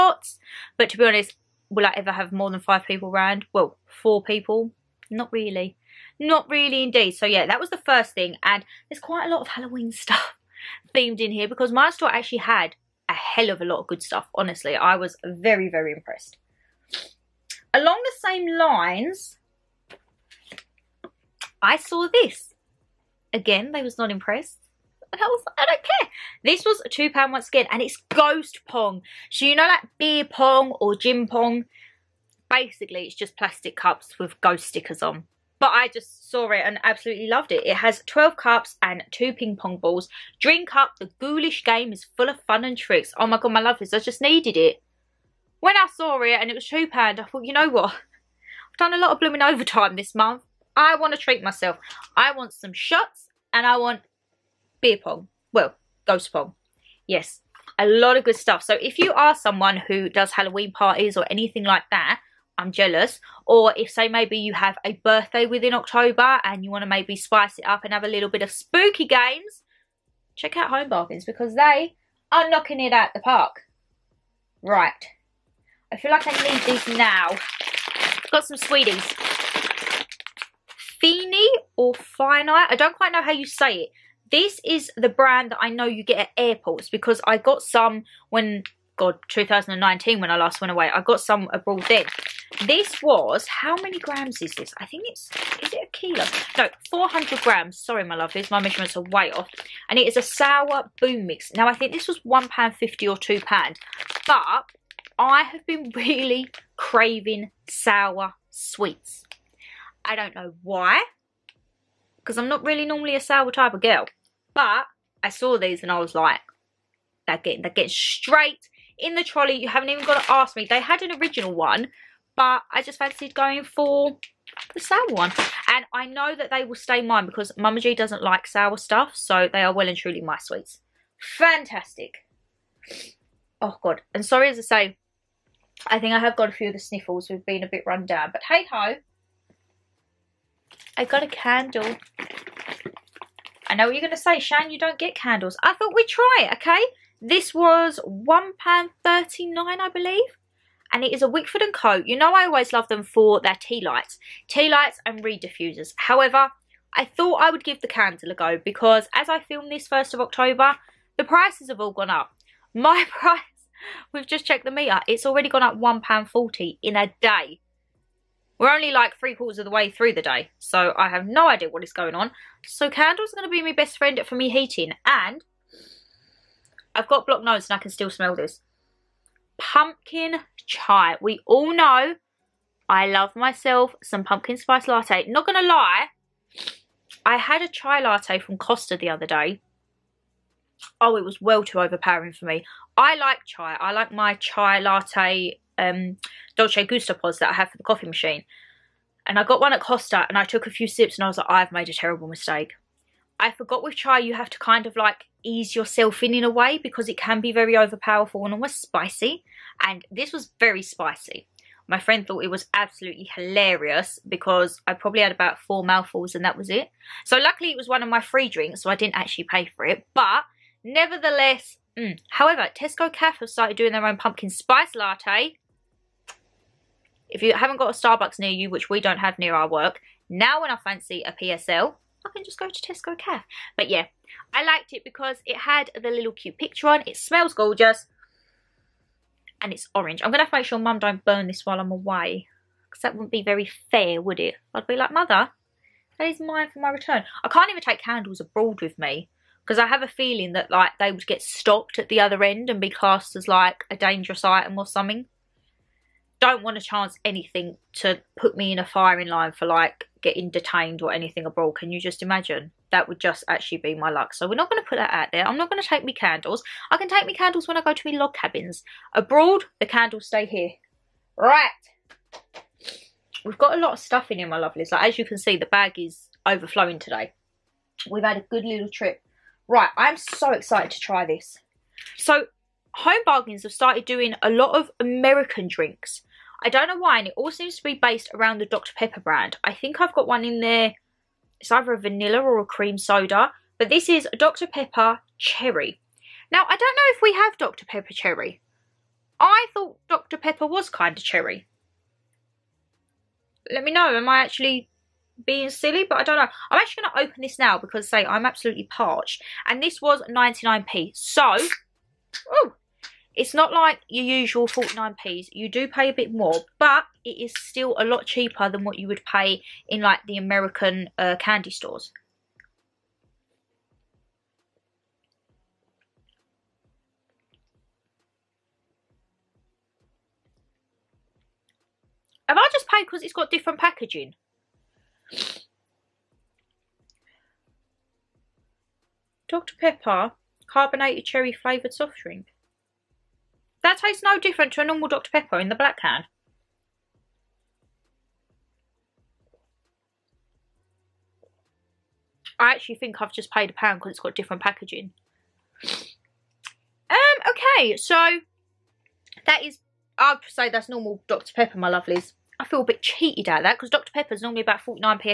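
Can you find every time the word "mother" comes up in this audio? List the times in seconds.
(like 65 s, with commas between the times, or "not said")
245 s.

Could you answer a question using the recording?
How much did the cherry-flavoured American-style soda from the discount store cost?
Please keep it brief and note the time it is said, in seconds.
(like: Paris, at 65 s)
99p, at 310 s.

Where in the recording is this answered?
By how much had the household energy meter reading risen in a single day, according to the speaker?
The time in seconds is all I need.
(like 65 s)
165 s.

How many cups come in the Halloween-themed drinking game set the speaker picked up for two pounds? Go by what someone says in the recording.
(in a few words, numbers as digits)
12.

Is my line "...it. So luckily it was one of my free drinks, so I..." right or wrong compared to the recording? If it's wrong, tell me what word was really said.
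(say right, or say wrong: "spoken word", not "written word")
right.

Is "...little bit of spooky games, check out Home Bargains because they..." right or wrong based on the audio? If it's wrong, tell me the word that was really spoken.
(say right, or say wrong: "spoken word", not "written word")
right.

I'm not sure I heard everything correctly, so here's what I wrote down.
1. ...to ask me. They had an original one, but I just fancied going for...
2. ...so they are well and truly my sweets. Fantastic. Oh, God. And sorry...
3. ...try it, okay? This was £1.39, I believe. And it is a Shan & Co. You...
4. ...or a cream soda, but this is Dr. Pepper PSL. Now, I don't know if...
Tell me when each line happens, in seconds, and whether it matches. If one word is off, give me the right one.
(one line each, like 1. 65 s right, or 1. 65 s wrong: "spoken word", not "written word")
1. 120 s right
2. 129 s right
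3. 146 s wrong: "Wickford", not "Shan"
4. 292 s wrong: "Cherry", not "PSL".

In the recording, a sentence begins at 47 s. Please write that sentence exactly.
I've done a lot of blooming overtime this month.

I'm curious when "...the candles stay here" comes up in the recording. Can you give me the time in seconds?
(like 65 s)
269 s.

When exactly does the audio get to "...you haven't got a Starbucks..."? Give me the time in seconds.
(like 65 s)
227 s.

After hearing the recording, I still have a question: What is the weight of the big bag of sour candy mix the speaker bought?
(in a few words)
400 grams.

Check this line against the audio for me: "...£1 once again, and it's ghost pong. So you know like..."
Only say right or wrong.
wrong.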